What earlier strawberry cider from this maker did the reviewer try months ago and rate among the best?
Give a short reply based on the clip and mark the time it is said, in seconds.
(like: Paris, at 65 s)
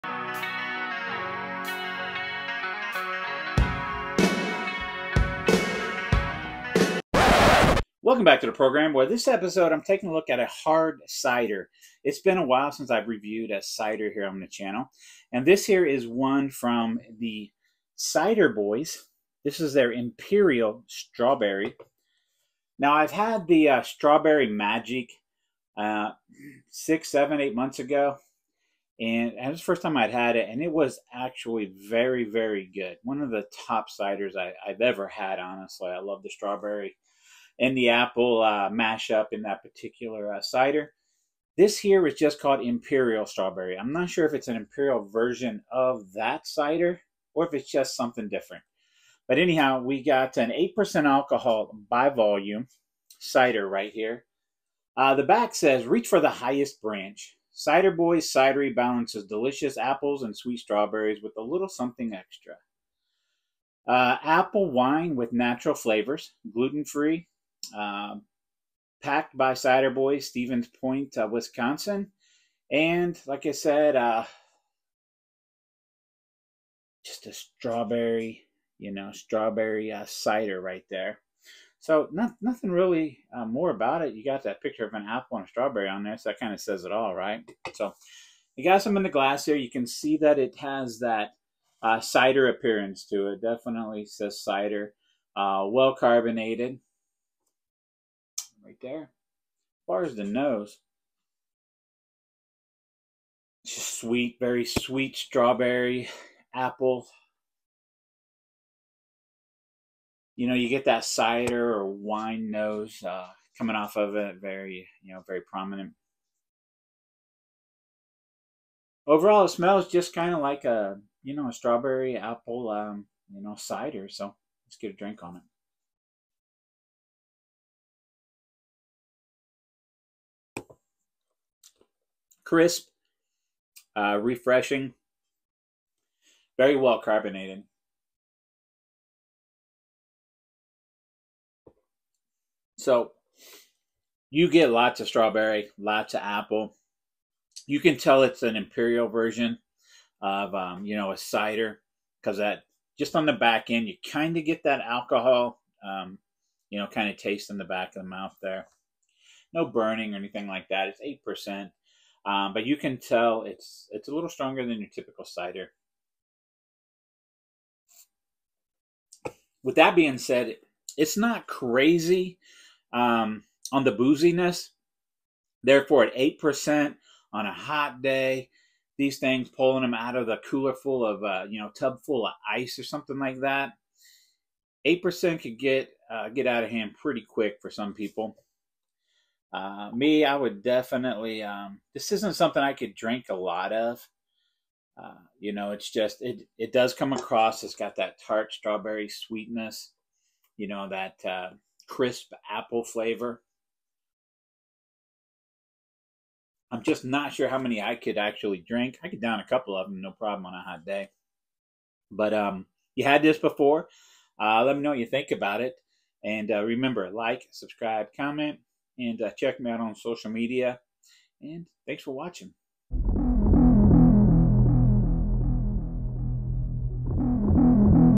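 Strawberry Magic, at 23 s.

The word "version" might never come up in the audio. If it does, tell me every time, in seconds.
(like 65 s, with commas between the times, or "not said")
45 s, 149 s.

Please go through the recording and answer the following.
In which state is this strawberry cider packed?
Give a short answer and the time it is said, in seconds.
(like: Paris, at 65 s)
Wisconsin, at 71 s.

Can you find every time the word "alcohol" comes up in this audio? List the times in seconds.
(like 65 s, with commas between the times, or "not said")
51 s, 154 s.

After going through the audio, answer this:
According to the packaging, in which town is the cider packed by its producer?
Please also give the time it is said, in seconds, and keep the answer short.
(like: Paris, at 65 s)
Stevens Point, at 70 s.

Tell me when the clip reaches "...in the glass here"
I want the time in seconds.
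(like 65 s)
88 s.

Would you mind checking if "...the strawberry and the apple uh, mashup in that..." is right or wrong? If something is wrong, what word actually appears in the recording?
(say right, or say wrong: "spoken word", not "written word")
right.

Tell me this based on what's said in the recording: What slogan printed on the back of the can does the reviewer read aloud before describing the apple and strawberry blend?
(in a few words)
Reach for the highest branch.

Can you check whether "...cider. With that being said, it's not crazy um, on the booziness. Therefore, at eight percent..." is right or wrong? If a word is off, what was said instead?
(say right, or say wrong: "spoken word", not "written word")
right.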